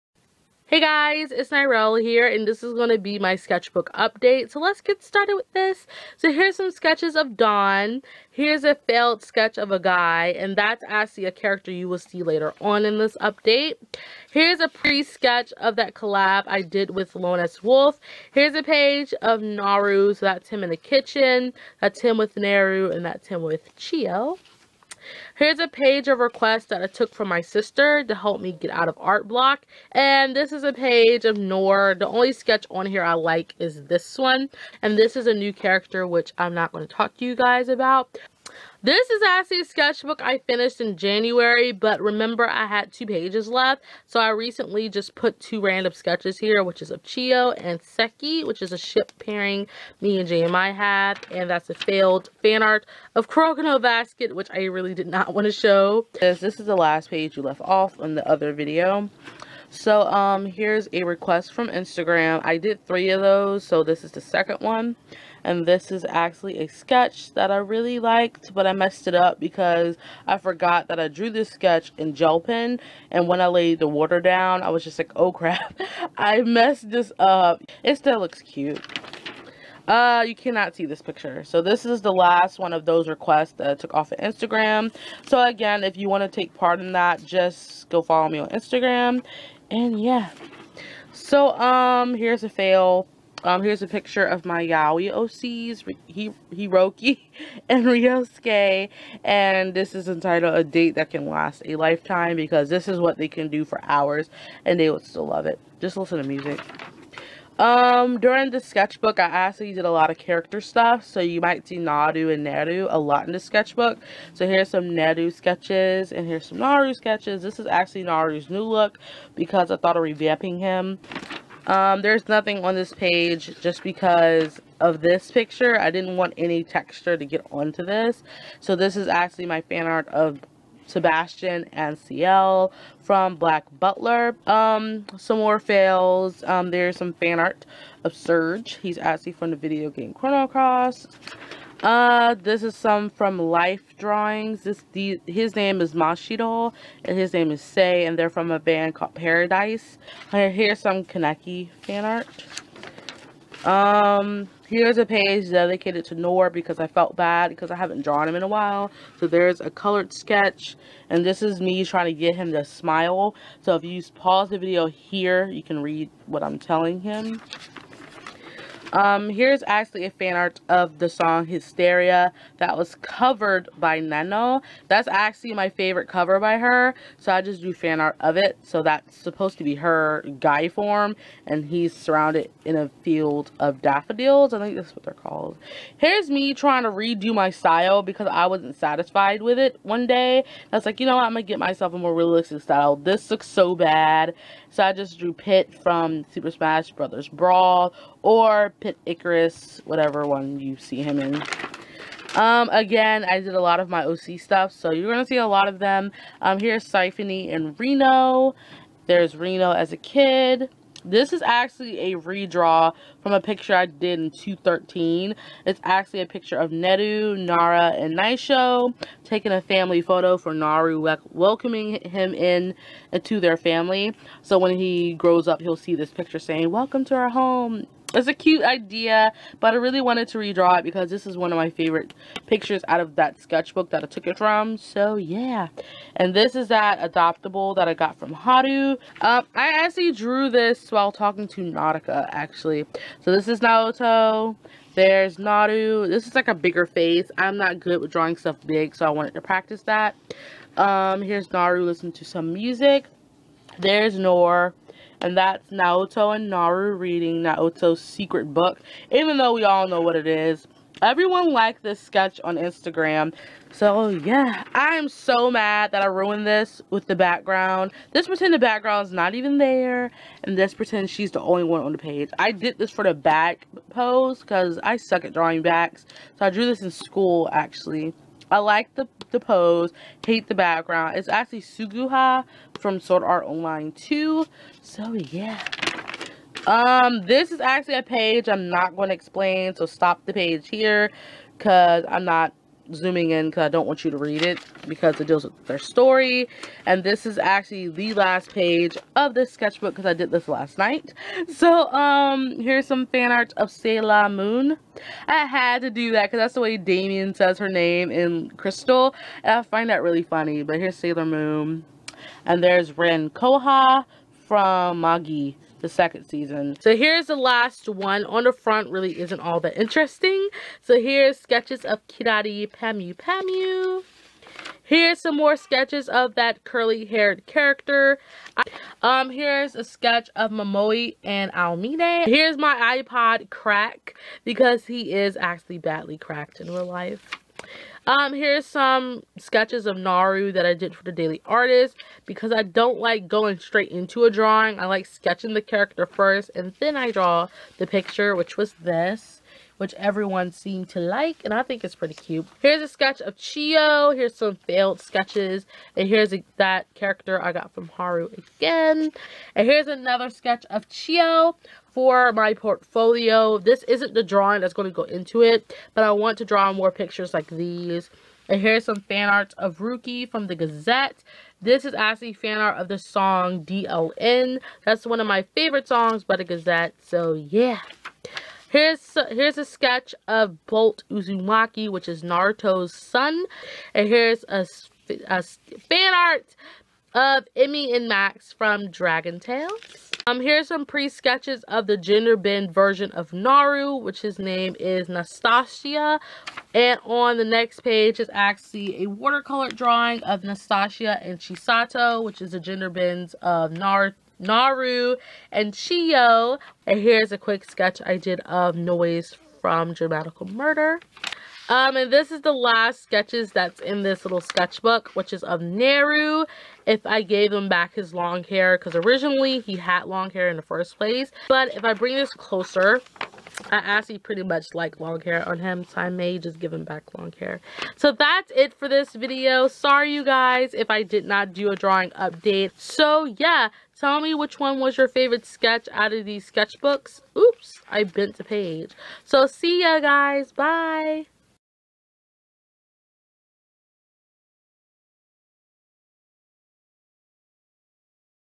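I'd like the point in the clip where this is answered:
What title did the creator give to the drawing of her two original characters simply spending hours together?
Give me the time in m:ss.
1:40.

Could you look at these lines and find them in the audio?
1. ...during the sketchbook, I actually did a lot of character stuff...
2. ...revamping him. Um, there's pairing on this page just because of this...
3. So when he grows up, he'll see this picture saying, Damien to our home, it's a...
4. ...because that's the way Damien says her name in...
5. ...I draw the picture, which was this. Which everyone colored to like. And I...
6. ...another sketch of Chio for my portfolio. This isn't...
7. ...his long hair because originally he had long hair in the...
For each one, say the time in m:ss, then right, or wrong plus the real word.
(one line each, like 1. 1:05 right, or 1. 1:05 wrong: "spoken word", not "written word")
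1. 1:48 right
2. 2:00 wrong: "nothing", not "pairing"
3. 3:44 wrong: "Welcome", not "Damien"
4. 5:06 right
5. 5:46 wrong: "seemed", not "colored"
6. 5:59 right
7. 6:57 right.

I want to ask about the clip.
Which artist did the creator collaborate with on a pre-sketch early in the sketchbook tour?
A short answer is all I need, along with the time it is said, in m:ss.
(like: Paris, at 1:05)
Lone S. Wolf, at 0:17.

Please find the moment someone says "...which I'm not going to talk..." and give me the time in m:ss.
0:36.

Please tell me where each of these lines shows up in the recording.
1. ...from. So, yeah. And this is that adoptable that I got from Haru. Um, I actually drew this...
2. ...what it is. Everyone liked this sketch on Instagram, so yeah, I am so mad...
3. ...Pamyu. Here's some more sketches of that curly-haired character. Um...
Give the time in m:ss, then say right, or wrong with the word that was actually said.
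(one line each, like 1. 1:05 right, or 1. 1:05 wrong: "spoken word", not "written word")
1. 3:54 right
2. 4:20 right
3. 5:23 right.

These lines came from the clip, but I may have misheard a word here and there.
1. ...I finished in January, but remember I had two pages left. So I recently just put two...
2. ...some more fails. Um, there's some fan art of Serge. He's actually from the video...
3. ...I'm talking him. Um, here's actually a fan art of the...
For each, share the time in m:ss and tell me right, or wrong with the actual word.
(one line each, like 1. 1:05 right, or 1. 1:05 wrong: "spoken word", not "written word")
1. 0:40 right
2. 2:15 right
3. 2:46 wrong: "telling", not "talking".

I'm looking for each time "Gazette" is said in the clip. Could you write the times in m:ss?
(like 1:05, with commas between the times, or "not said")
6:10, 6:16.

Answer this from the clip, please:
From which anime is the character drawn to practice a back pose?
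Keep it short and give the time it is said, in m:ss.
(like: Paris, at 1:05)
Sword Art Online 2, at 4:42.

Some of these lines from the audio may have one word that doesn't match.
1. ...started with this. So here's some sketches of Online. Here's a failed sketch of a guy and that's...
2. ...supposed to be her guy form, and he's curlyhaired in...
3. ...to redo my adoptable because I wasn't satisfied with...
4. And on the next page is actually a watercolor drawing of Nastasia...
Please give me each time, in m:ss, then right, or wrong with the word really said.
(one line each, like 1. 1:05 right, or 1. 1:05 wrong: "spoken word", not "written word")
1. 0:05 wrong: "Dawn", not "Online"
2. 2:59 wrong: "surrounded", not "curlyhaired"
3. 3:06 wrong: "style", not "adoptable"
4. 6:36 right.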